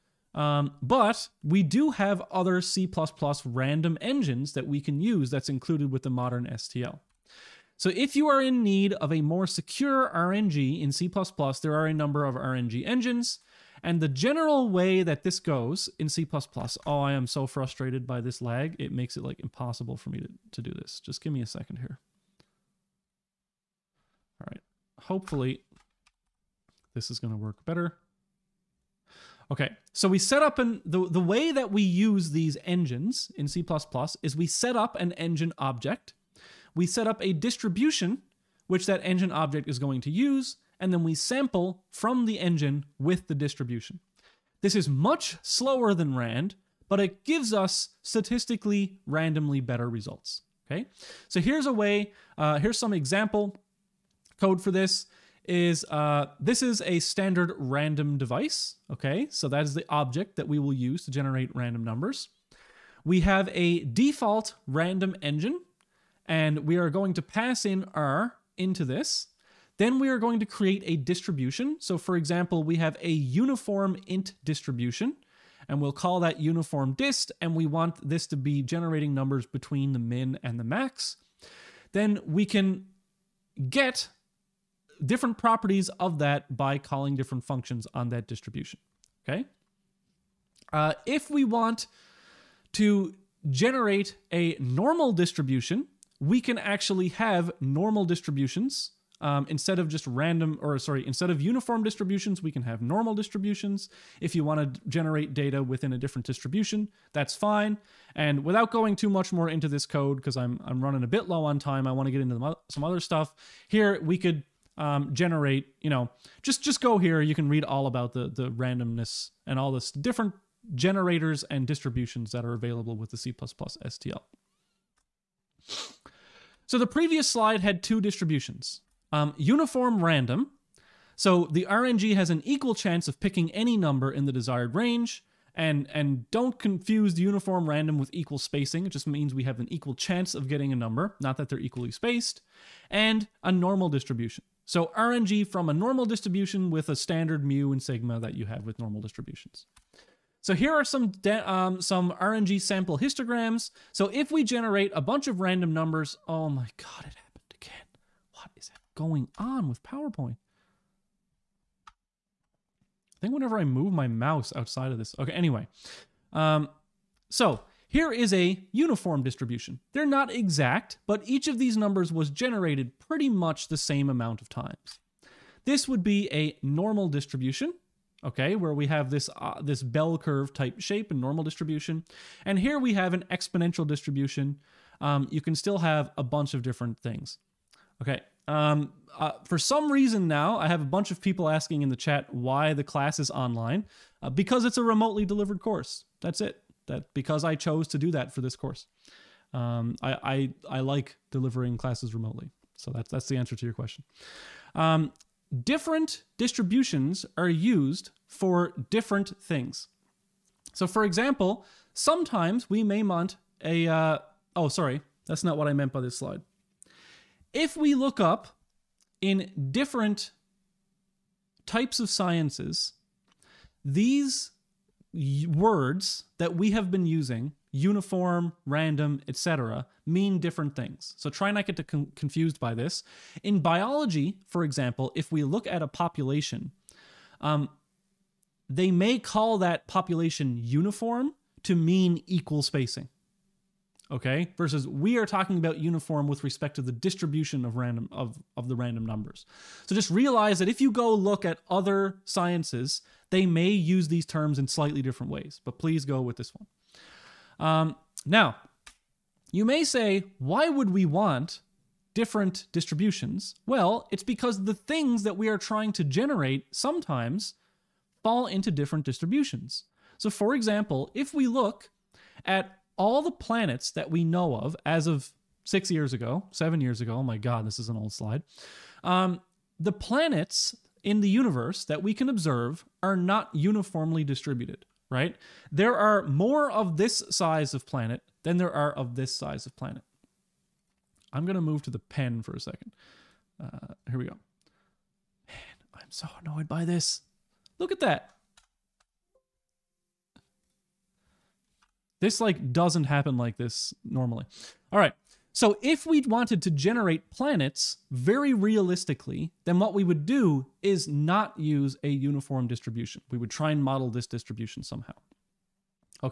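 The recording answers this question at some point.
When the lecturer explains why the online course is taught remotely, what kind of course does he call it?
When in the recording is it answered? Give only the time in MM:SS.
03:14.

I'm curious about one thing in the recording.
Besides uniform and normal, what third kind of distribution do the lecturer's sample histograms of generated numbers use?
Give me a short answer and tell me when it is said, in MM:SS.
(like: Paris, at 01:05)
exponential distribution, at 03:03.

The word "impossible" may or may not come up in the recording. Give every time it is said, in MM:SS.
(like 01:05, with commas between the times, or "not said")
00:19.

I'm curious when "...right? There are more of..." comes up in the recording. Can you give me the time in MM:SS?
04:45.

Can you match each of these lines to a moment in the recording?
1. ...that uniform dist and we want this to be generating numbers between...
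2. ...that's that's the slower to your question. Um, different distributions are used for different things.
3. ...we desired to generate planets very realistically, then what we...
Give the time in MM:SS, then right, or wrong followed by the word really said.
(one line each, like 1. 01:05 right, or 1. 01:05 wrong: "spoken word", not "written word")
1. 01:16 right
2. 03:22 wrong: "answer", not "slower"
3. 05:06 wrong: "wanted", not "desired".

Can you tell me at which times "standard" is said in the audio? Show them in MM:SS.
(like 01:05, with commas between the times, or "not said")
00:56, 02:26.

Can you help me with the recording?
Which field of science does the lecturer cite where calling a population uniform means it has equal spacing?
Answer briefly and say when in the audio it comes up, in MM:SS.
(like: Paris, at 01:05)
biology, at 03:53.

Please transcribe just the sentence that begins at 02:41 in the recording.
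I think whenever I move my mouse outside of this.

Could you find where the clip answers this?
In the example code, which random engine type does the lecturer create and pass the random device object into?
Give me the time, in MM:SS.
01:03.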